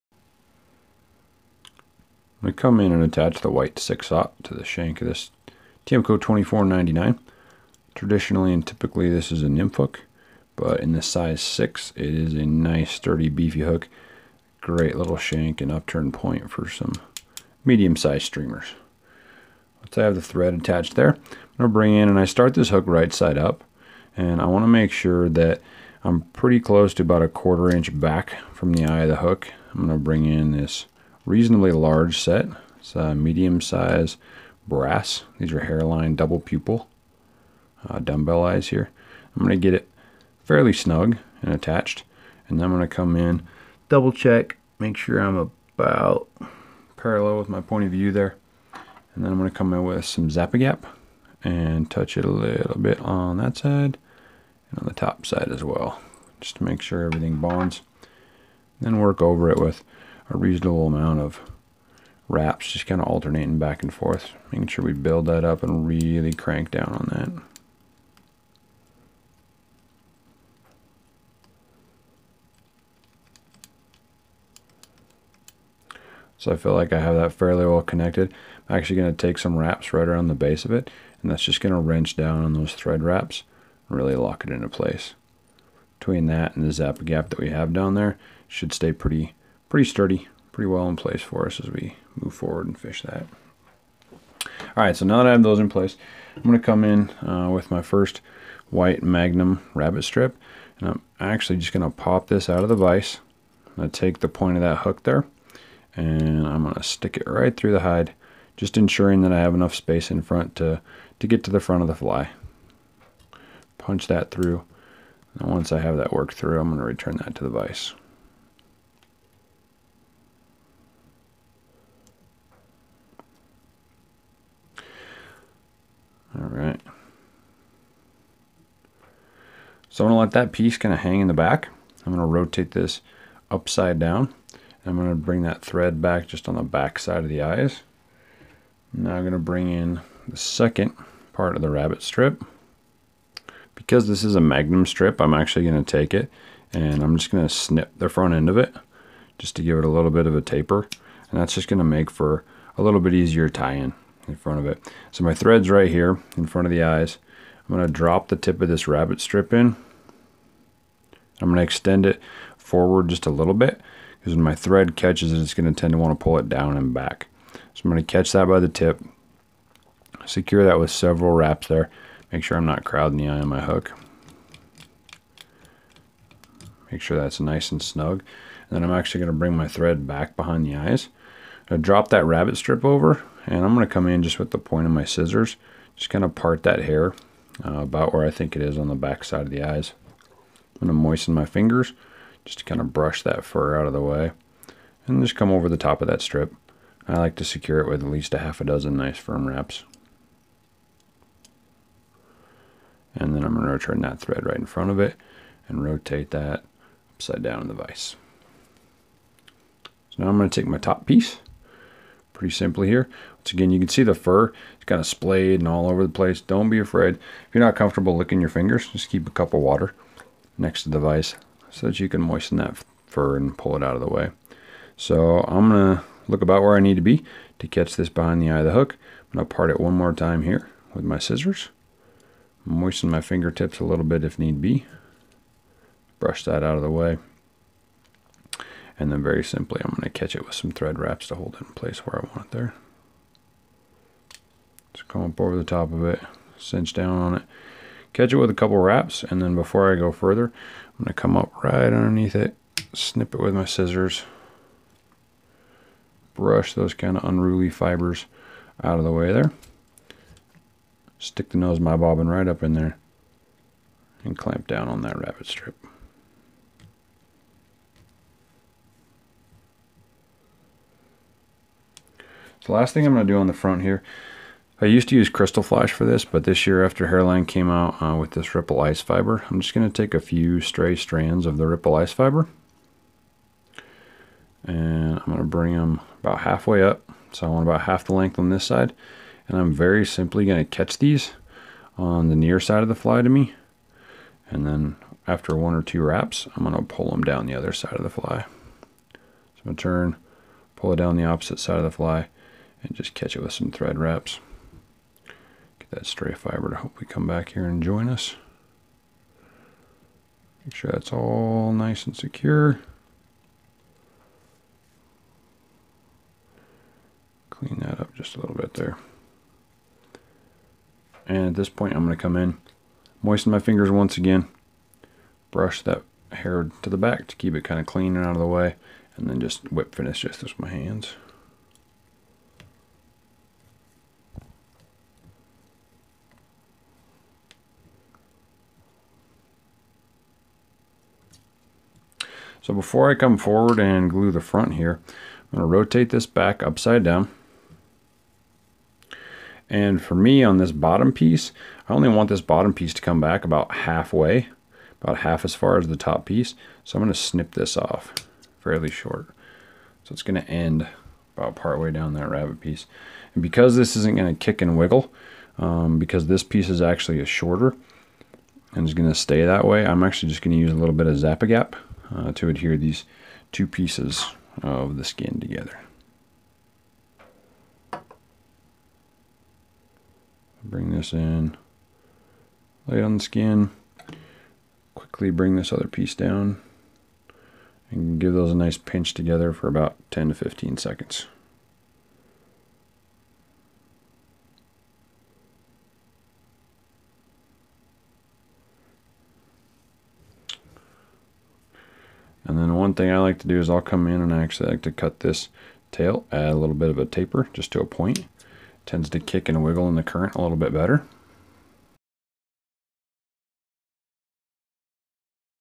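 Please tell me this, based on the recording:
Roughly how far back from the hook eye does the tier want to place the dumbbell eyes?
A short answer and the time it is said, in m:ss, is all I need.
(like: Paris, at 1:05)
a quarter inch, at 0:27.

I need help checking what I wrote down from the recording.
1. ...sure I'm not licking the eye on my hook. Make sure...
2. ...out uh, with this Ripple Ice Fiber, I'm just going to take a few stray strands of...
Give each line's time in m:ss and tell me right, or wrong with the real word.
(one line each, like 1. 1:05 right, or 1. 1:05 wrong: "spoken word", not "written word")
1. 2:52 wrong: "crowding", not "licking"
2. 4:37 right.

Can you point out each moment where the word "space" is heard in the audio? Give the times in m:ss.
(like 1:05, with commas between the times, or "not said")
1:49.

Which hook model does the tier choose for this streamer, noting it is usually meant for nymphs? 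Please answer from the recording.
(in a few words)
Tiemco 2499.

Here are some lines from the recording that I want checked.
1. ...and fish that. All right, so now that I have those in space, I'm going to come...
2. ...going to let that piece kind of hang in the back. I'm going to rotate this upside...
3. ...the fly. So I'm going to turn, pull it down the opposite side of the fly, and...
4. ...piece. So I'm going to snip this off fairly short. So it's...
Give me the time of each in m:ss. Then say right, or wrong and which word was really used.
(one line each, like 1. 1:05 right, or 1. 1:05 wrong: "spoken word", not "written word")
1. 1:32 wrong: "place", not "space"
2. 2:10 right
3. 4:58 right
4. 5:56 right.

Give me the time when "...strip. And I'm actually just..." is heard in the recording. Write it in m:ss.
1:40.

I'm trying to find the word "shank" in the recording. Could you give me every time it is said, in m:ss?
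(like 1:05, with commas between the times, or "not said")
0:04, 0:15.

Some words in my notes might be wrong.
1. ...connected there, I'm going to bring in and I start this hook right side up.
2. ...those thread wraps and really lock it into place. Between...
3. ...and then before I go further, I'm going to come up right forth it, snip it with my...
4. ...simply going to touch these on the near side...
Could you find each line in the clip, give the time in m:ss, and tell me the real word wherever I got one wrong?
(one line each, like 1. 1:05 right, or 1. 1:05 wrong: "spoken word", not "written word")
1. 0:20 wrong: "attached", not "connected"
2. 1:22 right
3. 4:09 wrong: "underneath", not "forth"
4. 4:50 wrong: "catch", not "touch".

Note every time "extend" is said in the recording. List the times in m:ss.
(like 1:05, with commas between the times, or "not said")
2:41.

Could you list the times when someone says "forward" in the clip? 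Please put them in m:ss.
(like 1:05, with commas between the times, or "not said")
1:32, 2:42, 5:43.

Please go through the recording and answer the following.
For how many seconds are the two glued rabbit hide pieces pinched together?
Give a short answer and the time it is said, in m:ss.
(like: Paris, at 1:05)
10 to 15, at 6:30.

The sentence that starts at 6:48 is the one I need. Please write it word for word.
Tends to kick and wiggle in the current a little bit better.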